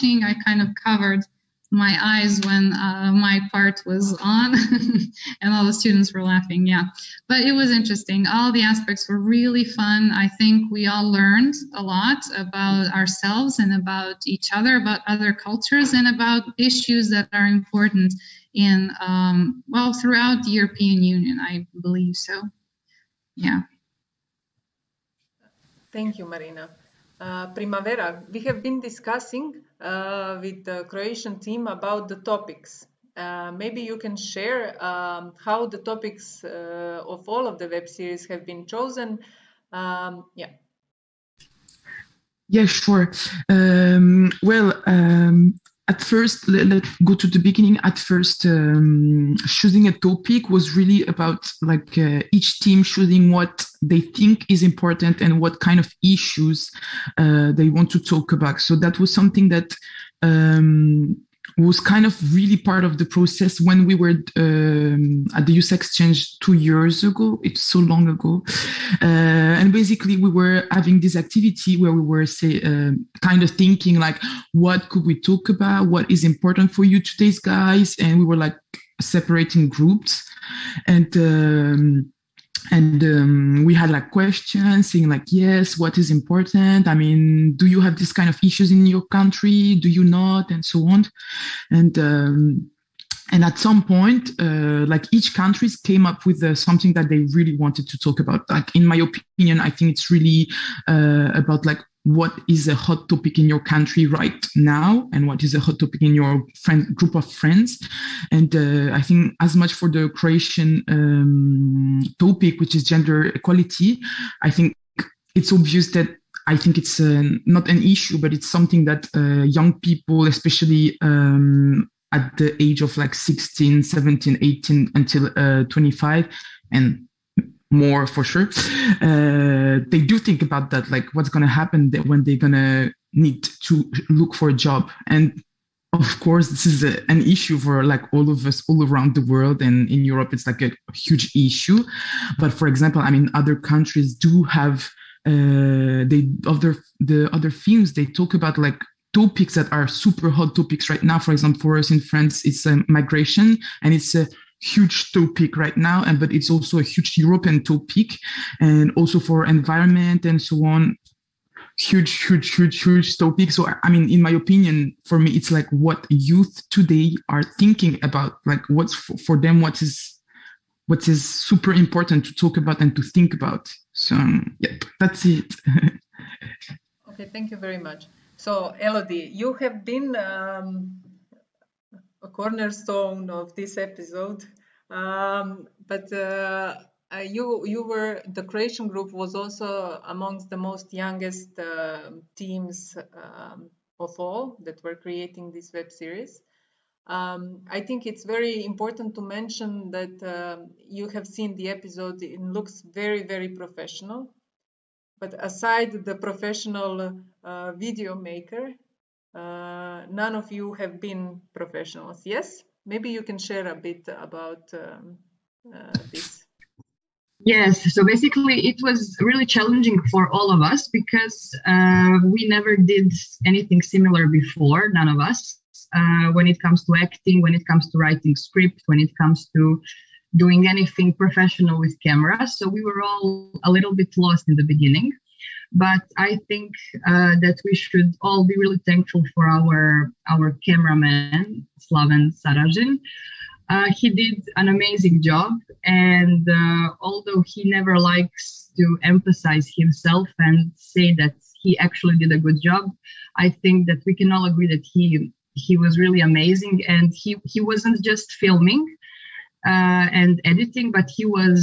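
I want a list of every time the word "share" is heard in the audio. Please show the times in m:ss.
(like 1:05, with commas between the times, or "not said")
0:34, 3:33.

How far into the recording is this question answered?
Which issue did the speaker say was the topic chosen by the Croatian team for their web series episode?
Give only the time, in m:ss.
1:52.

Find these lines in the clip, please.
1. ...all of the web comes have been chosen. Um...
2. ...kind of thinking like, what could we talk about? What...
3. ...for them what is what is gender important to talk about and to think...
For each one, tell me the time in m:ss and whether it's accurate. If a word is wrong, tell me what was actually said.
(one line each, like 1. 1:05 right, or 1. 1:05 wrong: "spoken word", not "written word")
1. 0:37 wrong: "series", not "comes"
2. 1:13 right
3. 2:49 wrong: "super", not "gender".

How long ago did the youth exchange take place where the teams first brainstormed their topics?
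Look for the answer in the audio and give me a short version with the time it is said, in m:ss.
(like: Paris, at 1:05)
2 years ago, at 1:06.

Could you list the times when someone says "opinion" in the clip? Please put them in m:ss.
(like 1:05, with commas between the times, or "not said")
1:38, 2:44.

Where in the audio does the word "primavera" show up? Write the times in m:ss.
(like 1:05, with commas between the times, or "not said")
0:27.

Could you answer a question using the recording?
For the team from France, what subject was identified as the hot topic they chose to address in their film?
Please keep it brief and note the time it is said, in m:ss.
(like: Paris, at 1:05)
Migration, at 2:32.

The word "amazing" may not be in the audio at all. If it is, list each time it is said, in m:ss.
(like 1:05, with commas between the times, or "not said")
4:04, 4:16.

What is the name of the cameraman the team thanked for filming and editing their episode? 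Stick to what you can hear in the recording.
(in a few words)
Slaven Sarajin.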